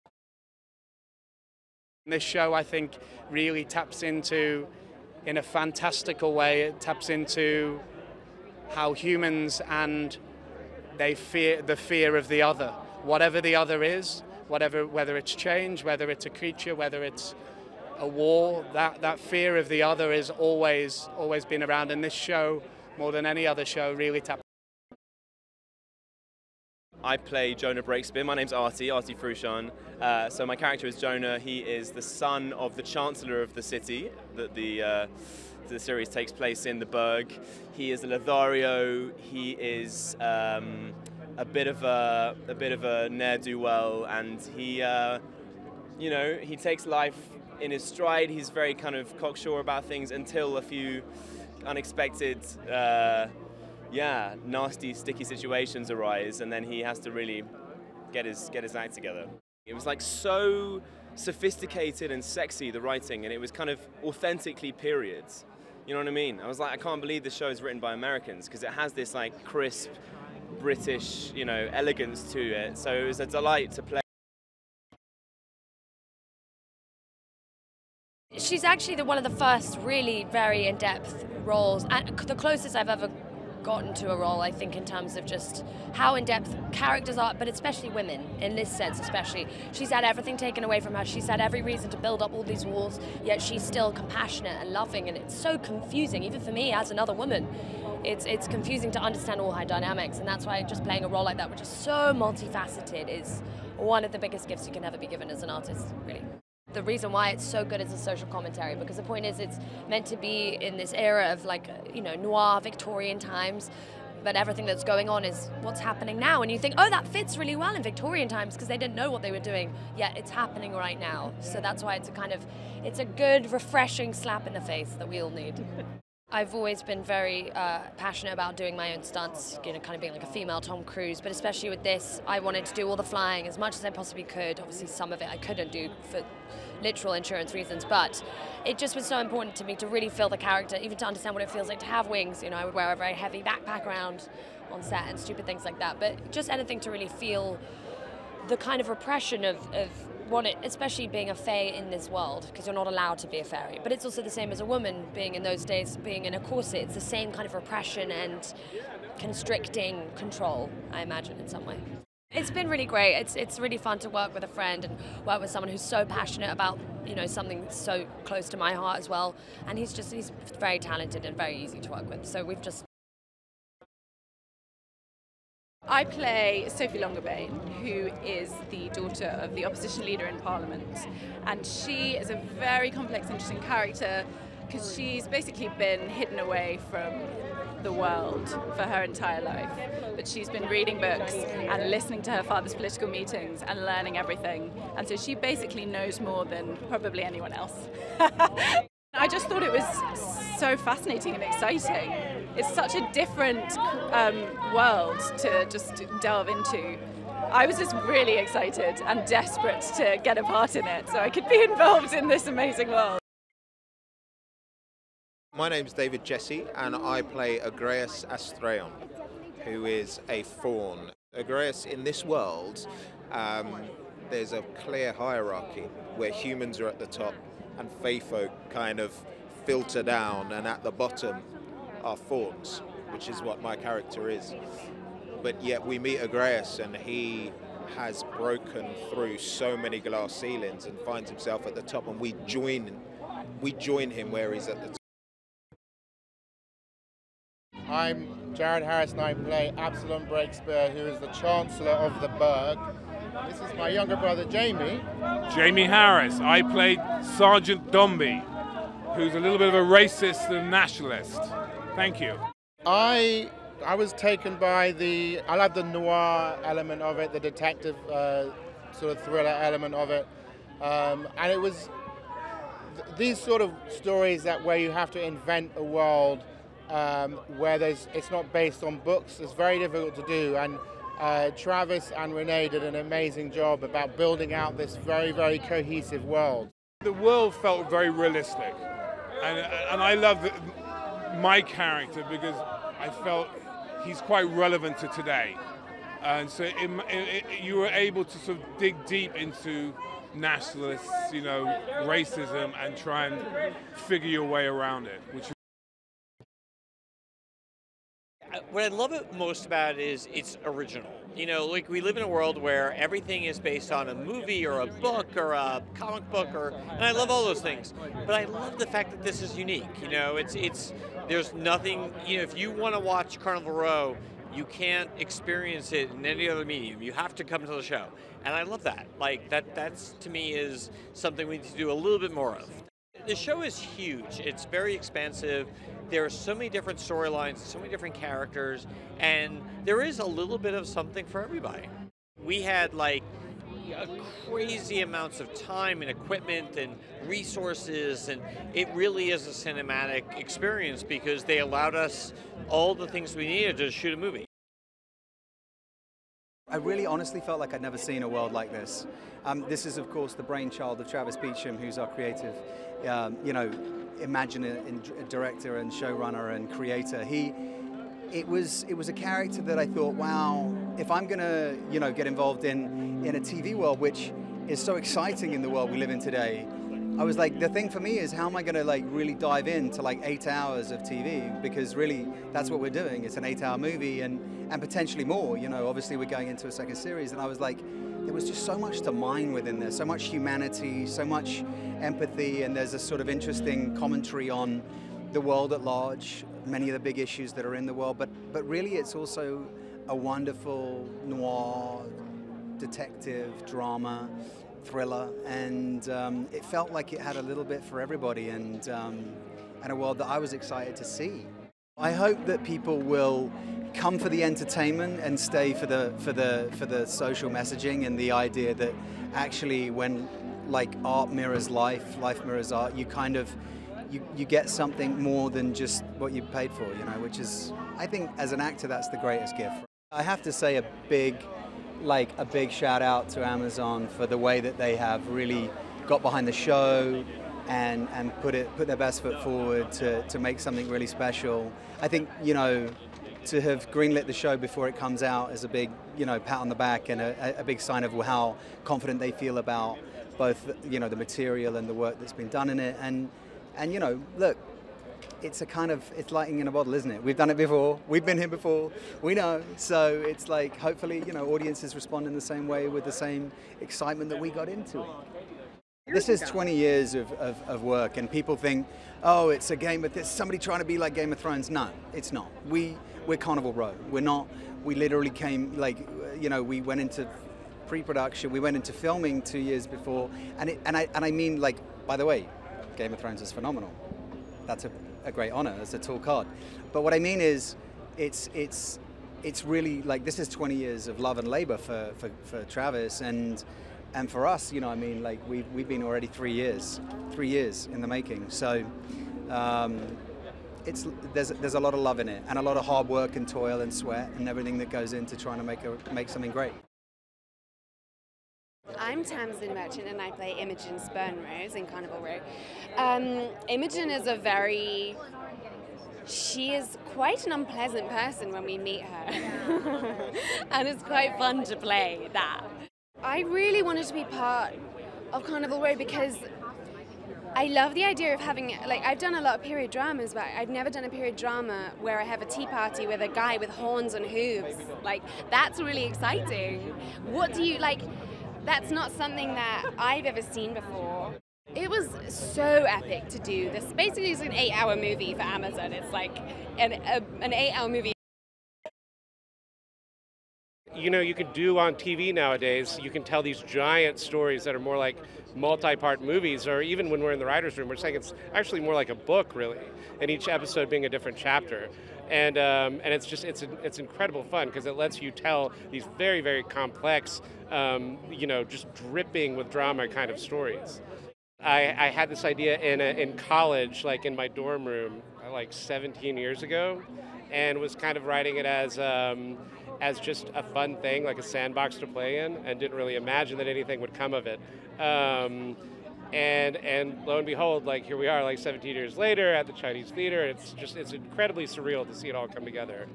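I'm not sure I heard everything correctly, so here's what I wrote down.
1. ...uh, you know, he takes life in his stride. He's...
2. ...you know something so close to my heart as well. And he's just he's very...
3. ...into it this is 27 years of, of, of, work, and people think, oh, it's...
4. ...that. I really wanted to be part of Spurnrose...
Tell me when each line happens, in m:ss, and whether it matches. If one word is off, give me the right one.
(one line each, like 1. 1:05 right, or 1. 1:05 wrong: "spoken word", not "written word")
1. 0:44 right
2. 2:47 right
3. 7:44 wrong: "20", not "27"
4. 8:42 wrong: "Carnival", not "Spurnrose".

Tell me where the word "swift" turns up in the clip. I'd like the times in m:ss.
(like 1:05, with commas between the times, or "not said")
not said.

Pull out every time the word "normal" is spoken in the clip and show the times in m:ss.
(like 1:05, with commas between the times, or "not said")
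not said.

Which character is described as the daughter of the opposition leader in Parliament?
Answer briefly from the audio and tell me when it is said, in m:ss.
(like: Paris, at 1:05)
Sophie Longerbane, at 2:56.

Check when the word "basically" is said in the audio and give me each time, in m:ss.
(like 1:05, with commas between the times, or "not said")
3:05, 3:15, 9:03.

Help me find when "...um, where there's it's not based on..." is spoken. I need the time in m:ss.
4:36.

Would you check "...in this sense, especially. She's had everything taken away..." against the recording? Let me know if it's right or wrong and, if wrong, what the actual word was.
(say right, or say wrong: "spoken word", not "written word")
right.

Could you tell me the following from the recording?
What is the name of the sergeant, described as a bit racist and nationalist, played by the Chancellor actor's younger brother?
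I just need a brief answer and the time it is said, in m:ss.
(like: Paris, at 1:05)
Sergeant Dombey, at 4:17.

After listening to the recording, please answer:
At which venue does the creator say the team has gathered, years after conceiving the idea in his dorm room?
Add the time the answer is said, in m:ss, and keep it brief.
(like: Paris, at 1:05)
The Chinese Theater, at 9:49.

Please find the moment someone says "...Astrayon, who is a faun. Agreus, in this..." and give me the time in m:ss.
3:38.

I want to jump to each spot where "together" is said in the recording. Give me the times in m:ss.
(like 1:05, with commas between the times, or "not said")
0:58, 9:52.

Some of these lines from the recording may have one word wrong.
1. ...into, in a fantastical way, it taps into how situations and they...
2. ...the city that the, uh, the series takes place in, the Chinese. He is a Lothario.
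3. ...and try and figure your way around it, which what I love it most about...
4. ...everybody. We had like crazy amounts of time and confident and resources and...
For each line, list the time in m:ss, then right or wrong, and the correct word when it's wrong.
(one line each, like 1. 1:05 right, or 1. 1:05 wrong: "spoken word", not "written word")
1. 0:04 wrong: "humans", not "situations"
2. 0:33 wrong: "Burgue", not "Chinese"
3. 5:02 right
4. 5:41 wrong: "equipment", not "confident".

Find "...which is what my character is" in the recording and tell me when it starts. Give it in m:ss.
3:53.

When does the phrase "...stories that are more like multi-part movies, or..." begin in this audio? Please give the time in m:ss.
9:14.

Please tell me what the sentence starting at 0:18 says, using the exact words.
That that fear of the other is always always been around, and this show, more than any other show, really taps.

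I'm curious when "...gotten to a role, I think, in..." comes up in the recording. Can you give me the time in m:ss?
1:23.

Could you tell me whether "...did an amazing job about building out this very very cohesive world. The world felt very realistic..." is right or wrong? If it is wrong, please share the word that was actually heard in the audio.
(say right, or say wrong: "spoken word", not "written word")
right.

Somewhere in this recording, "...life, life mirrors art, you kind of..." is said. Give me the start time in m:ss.
7:01.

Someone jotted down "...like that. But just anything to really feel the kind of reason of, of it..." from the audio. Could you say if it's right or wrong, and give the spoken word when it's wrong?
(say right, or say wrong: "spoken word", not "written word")
wrong: "repression", not "reason".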